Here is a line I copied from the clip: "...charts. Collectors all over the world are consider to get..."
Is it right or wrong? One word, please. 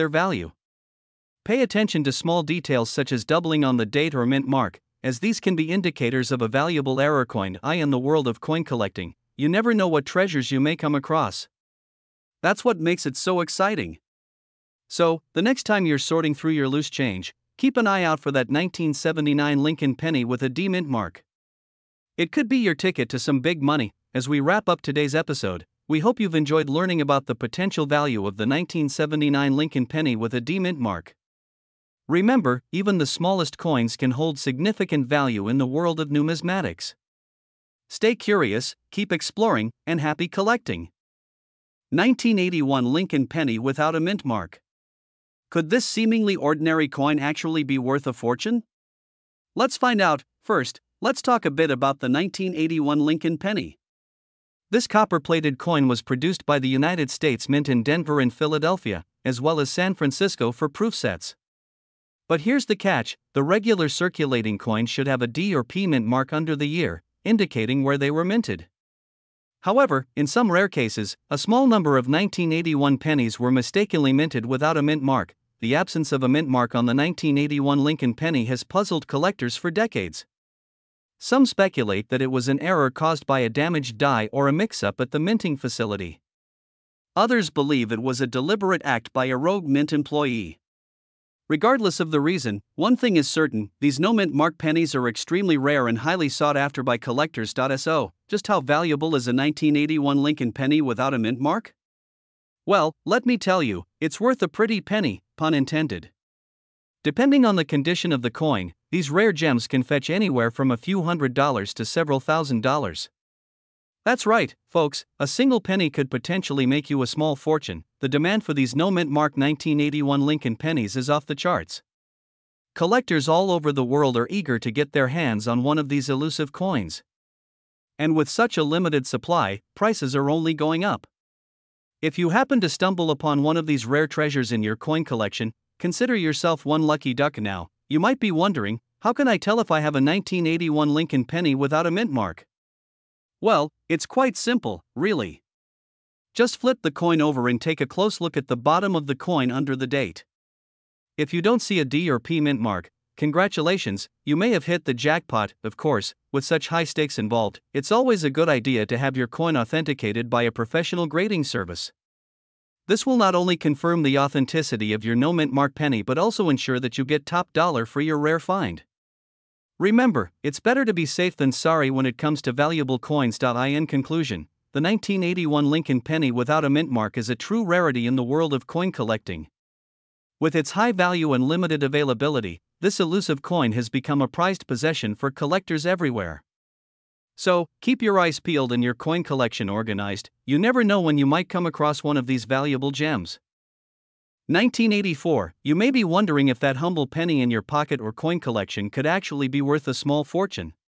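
wrong.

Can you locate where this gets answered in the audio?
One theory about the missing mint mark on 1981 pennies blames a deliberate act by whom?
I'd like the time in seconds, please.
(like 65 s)
89 s.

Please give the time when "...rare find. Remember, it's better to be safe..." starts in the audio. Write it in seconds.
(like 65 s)
168 s.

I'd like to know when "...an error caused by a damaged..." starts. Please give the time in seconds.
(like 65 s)
82 s.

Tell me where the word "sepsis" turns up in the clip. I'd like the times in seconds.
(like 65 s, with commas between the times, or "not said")
not said.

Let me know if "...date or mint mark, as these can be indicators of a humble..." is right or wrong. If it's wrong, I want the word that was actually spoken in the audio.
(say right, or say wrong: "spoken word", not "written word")
wrong: "valuable", not "humble".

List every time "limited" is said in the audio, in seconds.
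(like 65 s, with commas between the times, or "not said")
128 s, 181 s.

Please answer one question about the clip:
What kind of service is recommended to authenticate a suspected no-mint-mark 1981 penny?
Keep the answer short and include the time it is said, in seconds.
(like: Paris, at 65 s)
professional grading service, at 160 s.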